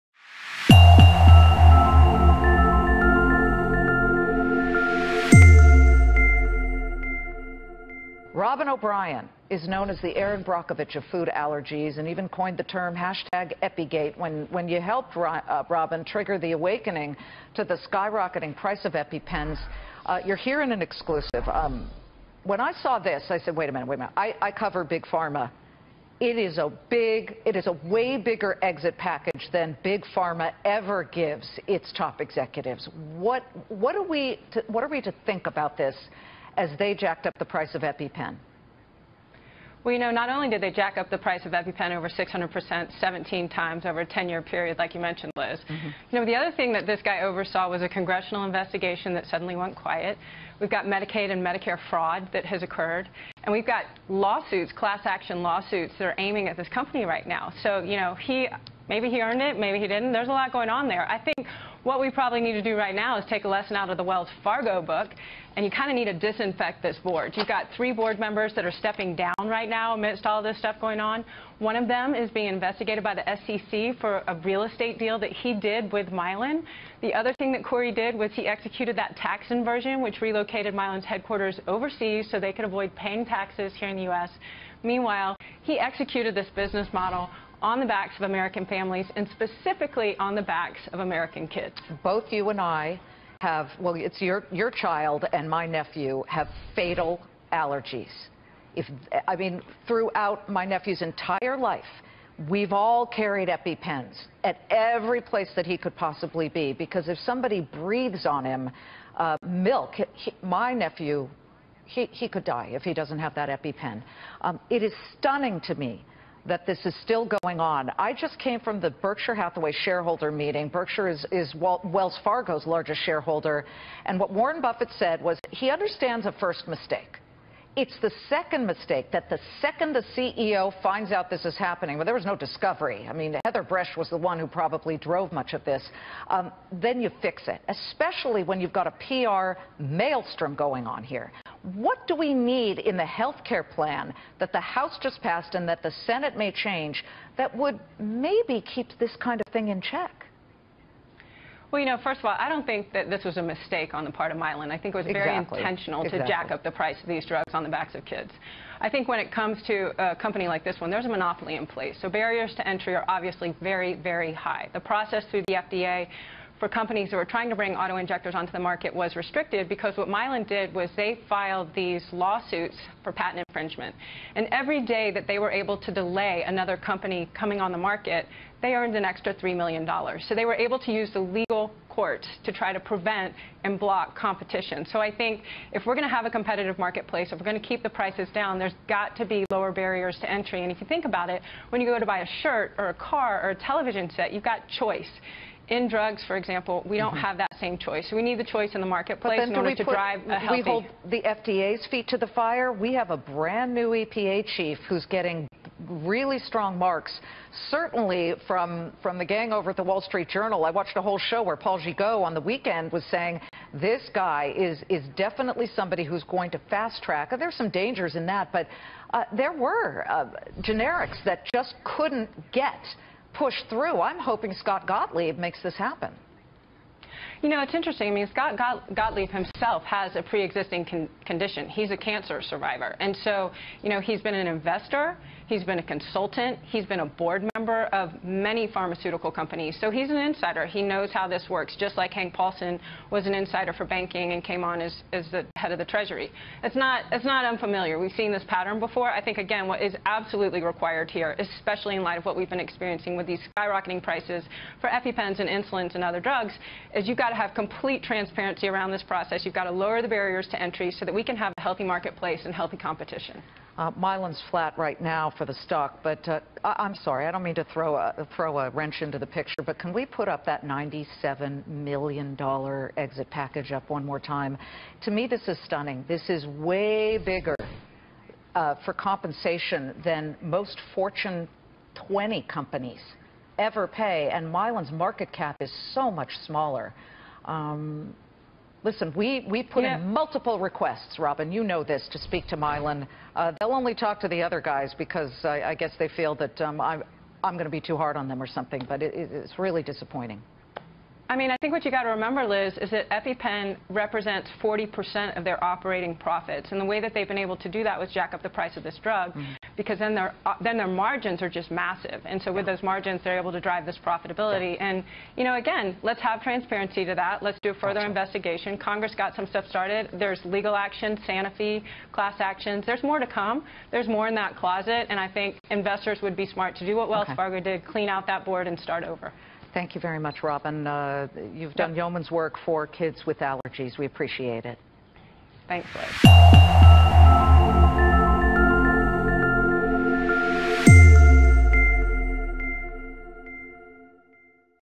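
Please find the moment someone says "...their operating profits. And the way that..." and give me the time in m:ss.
5:05.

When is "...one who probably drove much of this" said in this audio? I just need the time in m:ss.
2:14.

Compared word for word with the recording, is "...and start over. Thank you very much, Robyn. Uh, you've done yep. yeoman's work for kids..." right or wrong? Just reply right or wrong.
right.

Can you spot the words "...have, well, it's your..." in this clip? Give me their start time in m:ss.
1:33.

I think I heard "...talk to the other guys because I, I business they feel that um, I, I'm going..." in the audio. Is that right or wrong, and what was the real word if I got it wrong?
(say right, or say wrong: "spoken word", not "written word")
wrong: "guess", not "business".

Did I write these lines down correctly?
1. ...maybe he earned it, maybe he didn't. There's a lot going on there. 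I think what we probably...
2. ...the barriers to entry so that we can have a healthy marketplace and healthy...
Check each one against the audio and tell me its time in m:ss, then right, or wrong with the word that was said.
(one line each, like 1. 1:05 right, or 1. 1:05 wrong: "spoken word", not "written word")
1. 0:58 right
2. 4:20 right.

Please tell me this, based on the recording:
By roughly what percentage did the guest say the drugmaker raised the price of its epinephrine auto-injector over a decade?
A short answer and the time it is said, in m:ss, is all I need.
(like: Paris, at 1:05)
600%, at 0:42.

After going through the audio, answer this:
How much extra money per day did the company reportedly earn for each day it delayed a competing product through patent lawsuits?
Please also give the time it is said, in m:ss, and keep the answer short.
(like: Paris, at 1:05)
$3 million, at 2:59.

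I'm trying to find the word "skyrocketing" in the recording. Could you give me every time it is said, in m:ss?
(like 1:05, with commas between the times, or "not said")
0:17, 4:13.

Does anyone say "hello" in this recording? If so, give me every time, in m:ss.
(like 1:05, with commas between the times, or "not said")
not said.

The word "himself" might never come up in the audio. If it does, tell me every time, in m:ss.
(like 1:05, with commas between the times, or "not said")
3:49.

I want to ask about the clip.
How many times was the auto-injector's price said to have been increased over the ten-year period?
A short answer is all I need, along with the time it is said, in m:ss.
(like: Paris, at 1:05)
17, at 0:42.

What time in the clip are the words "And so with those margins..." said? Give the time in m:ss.
5:12.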